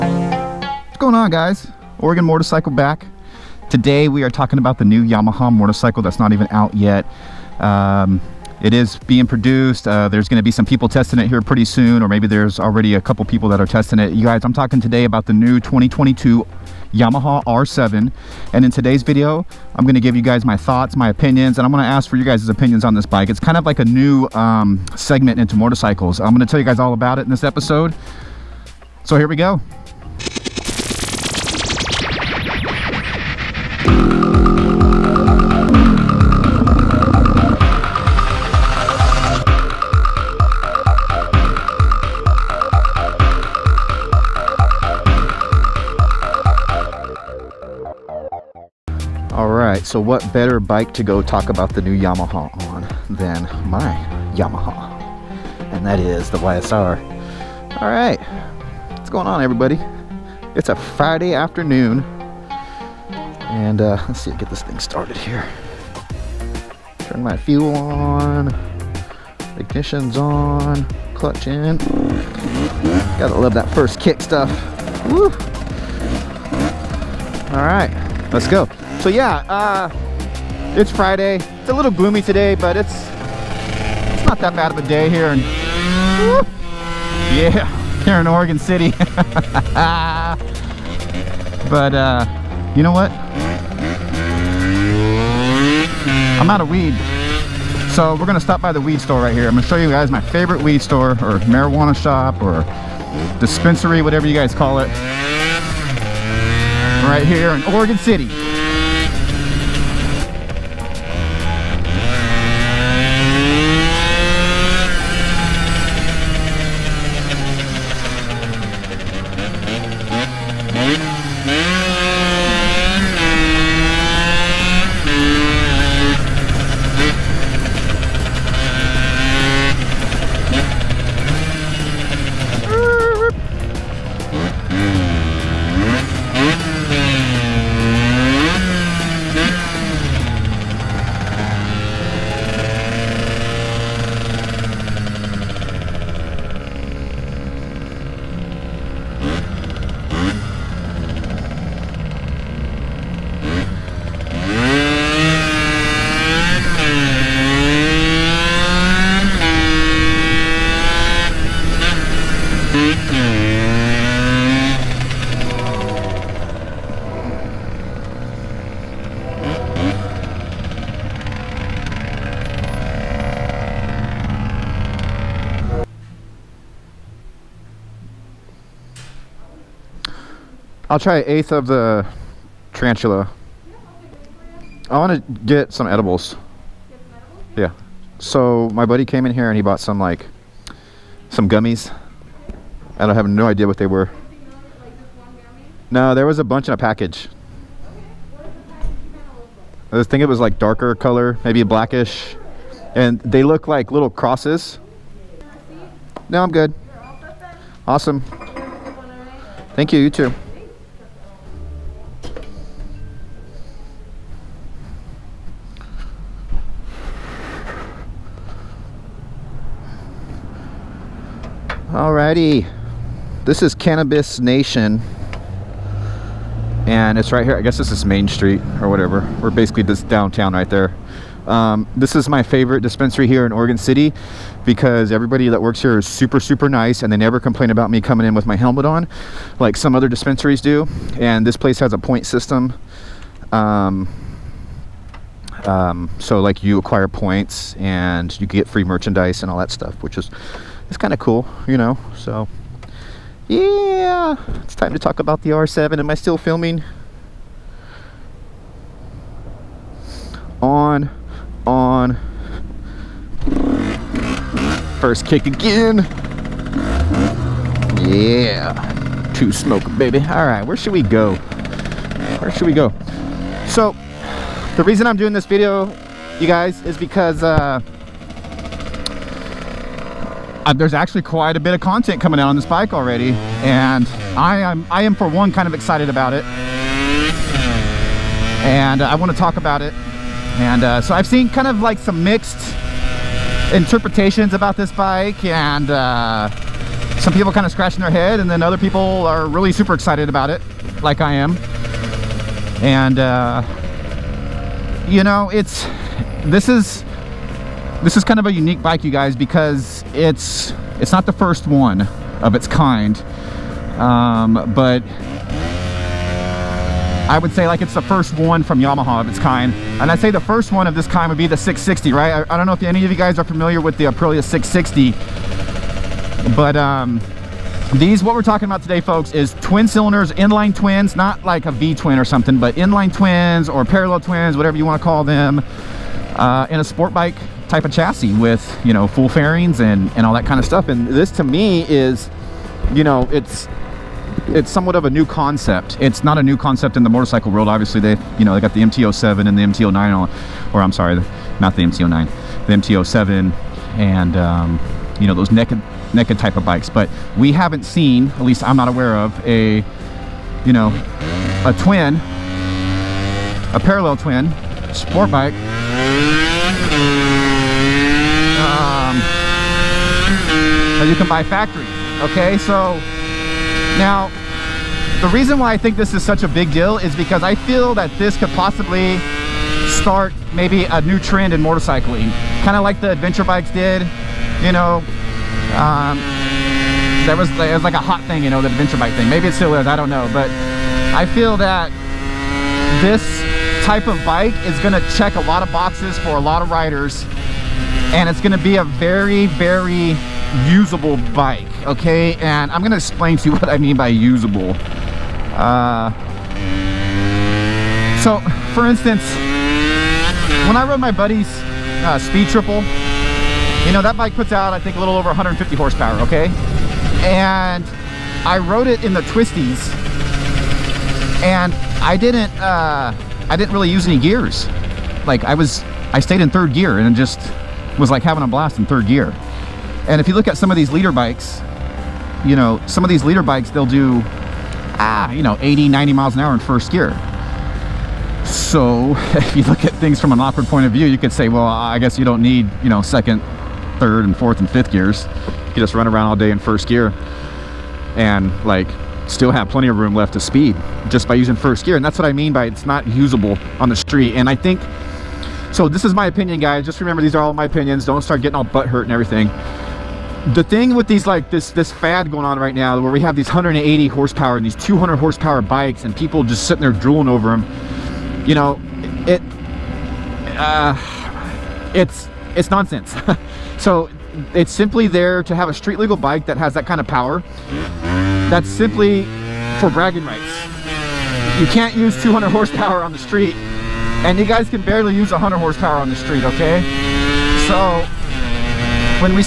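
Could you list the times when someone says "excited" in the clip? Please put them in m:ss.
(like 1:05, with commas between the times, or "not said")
4:45, 4:59.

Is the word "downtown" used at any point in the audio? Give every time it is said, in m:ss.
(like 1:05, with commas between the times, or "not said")
3:50.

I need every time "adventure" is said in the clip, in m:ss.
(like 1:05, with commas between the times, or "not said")
6:23, 6:28.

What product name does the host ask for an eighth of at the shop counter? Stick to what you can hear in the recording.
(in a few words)
tarantula.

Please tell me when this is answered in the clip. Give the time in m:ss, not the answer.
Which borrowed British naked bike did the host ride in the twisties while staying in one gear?
6:52.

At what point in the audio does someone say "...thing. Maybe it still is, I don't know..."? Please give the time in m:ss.
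6:29.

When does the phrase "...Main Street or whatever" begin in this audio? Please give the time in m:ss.
3:48.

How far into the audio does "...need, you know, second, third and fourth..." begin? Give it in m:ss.
7:22.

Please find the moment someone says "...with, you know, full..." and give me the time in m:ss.
5:38.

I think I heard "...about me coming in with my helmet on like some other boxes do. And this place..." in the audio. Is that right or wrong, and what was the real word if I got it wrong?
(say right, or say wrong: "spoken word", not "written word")
wrong: "dispensaries", not "boxes".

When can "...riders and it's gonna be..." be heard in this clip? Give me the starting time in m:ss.
6:36.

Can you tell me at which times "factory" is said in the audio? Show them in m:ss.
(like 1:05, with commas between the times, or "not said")
6:11.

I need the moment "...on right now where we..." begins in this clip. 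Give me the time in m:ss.
7:42.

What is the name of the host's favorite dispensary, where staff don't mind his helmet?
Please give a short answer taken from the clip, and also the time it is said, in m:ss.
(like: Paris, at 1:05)
Cannabis Nation, at 3:43.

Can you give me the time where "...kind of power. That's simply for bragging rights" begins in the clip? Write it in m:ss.
7:56.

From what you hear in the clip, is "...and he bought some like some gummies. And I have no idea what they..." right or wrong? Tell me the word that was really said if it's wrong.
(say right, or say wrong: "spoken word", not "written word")
right.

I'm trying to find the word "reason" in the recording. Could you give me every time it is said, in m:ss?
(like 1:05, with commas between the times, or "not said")
4:34, 6:15.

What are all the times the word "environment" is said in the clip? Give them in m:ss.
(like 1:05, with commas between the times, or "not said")
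not said.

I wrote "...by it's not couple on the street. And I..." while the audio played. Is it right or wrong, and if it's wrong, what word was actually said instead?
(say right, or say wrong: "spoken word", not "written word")
wrong: "usable", not "couple".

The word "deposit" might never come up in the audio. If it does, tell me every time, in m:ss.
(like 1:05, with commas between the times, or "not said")
not said.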